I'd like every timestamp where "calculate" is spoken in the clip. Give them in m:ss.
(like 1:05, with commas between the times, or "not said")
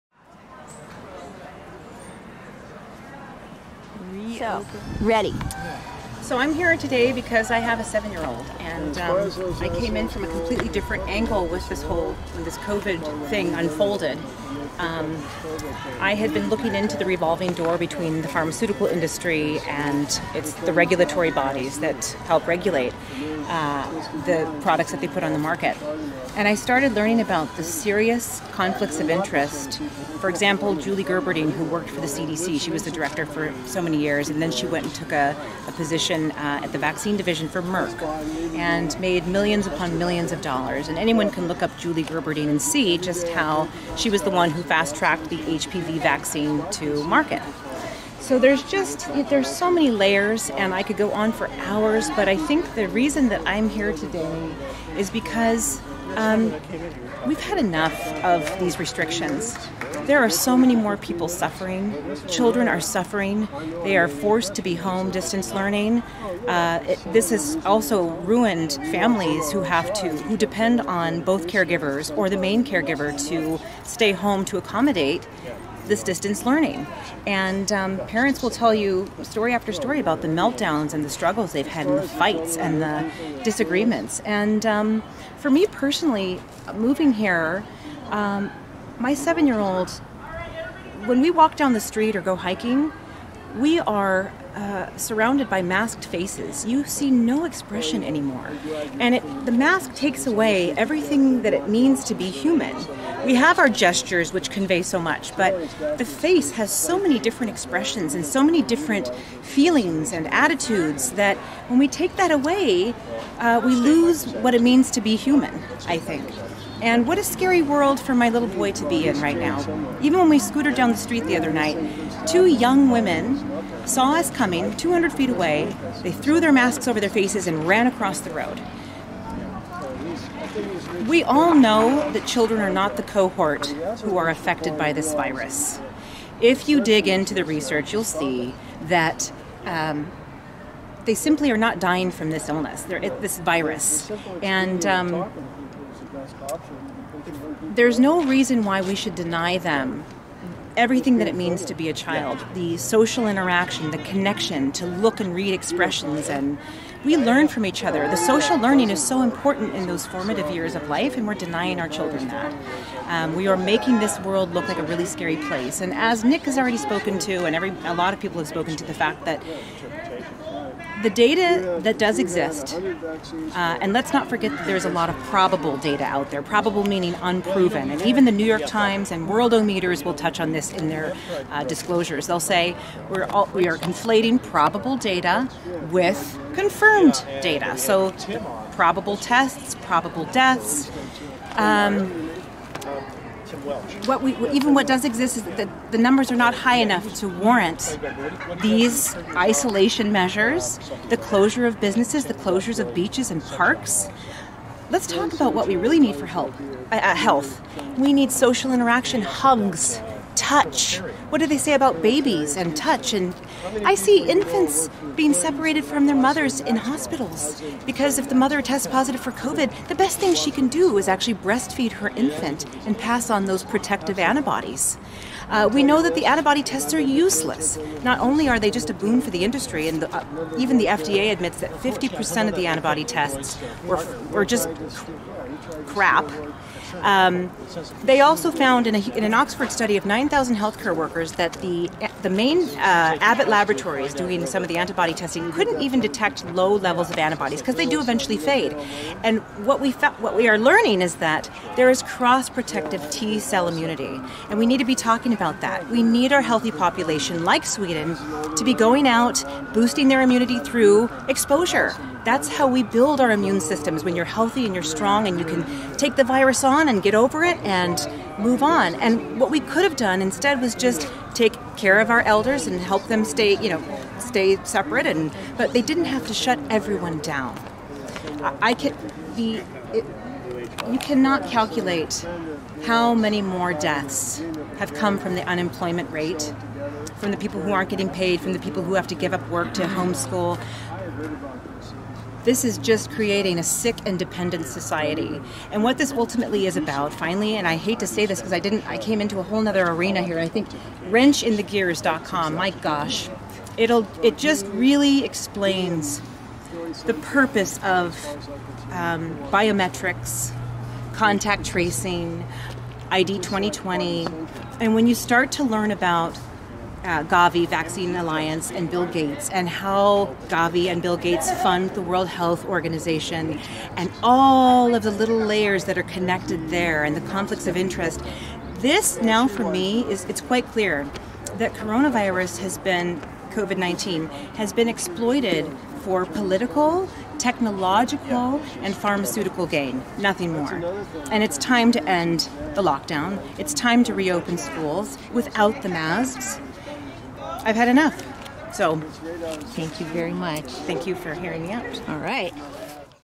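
4:41.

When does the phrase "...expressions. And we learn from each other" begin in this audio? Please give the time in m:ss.
2:35.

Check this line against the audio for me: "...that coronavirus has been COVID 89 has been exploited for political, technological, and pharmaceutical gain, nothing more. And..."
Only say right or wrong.
wrong.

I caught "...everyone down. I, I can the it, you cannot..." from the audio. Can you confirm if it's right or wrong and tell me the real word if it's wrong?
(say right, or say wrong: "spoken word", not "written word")
right.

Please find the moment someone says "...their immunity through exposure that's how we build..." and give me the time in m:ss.
4:20.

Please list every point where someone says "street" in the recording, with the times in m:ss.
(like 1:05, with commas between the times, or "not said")
1:31, 2:00.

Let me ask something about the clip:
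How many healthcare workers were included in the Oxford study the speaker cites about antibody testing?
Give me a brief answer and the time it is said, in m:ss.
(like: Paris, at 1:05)
9,000, at 4:00.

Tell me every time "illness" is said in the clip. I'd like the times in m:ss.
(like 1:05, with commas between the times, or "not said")
2:22.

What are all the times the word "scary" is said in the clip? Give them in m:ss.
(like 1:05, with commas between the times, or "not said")
1:57, 2:45.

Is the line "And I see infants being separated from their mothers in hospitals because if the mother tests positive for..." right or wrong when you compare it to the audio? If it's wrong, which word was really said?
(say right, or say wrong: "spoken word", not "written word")
right.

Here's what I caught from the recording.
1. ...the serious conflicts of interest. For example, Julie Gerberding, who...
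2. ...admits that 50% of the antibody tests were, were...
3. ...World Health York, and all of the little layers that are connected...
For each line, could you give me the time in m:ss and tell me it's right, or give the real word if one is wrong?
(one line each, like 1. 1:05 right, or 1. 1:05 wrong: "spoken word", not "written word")
1. 0:27 right
2. 3:51 right
3. 5:22 wrong: "Organization", not "York".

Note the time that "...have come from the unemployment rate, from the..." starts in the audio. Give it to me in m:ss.
4:44.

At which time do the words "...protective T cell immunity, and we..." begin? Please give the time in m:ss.
4:12.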